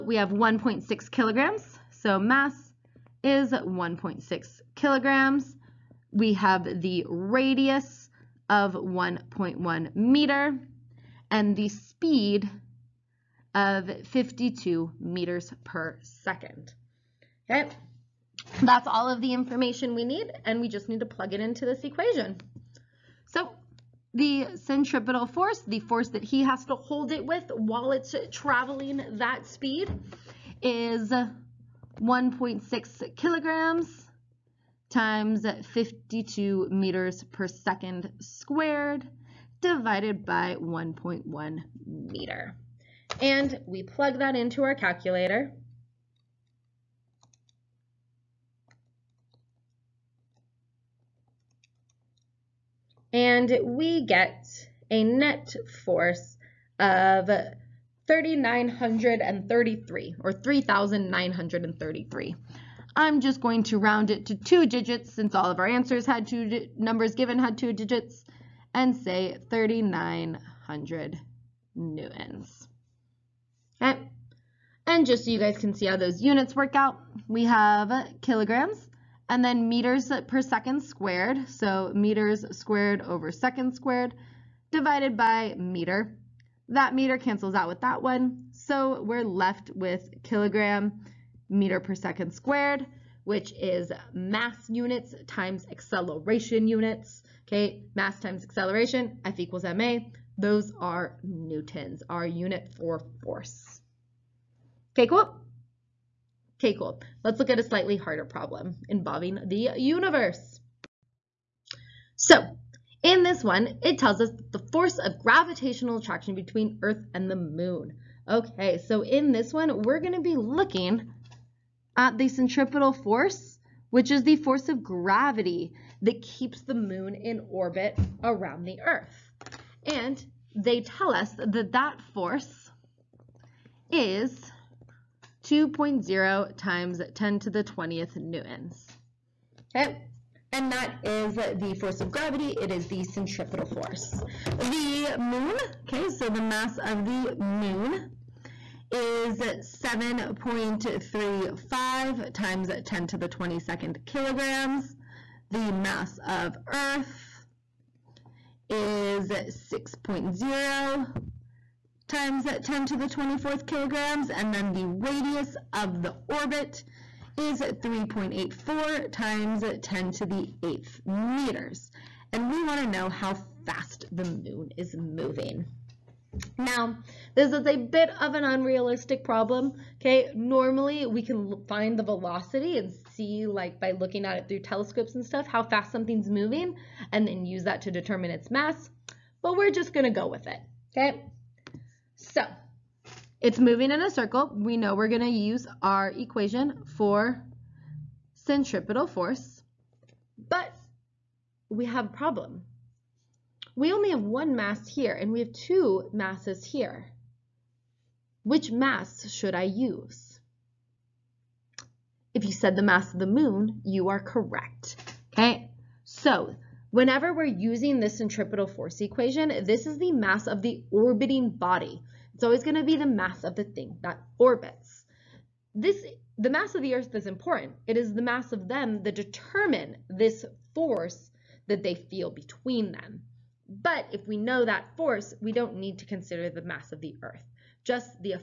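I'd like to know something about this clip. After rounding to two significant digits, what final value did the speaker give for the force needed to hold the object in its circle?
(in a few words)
3,900 newtons.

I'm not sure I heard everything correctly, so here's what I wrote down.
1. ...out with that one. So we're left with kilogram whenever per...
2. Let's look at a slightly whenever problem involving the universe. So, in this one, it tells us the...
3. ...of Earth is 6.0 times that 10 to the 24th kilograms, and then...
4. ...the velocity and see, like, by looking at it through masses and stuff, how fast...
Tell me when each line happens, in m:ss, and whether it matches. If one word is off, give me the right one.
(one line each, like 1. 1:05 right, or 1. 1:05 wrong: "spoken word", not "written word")
1. 1:27 wrong: "meter", not "whenever"
2. 1:47 wrong: "harder", not "whenever"
3. 2:36 right
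4. 3:01 wrong: "telescopes", not "masses".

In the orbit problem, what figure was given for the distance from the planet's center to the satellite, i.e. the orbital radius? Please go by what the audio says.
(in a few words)
3.84 x 10^8 meters.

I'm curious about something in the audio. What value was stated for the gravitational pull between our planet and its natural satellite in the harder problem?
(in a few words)
2.0 x 10^20 newtons.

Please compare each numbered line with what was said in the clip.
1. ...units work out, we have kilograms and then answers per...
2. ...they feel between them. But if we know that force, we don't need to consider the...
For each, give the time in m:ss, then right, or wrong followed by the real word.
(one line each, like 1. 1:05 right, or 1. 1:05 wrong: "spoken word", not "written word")
1. 1:16 wrong: "meters", not "answers"
2. 3:51 right.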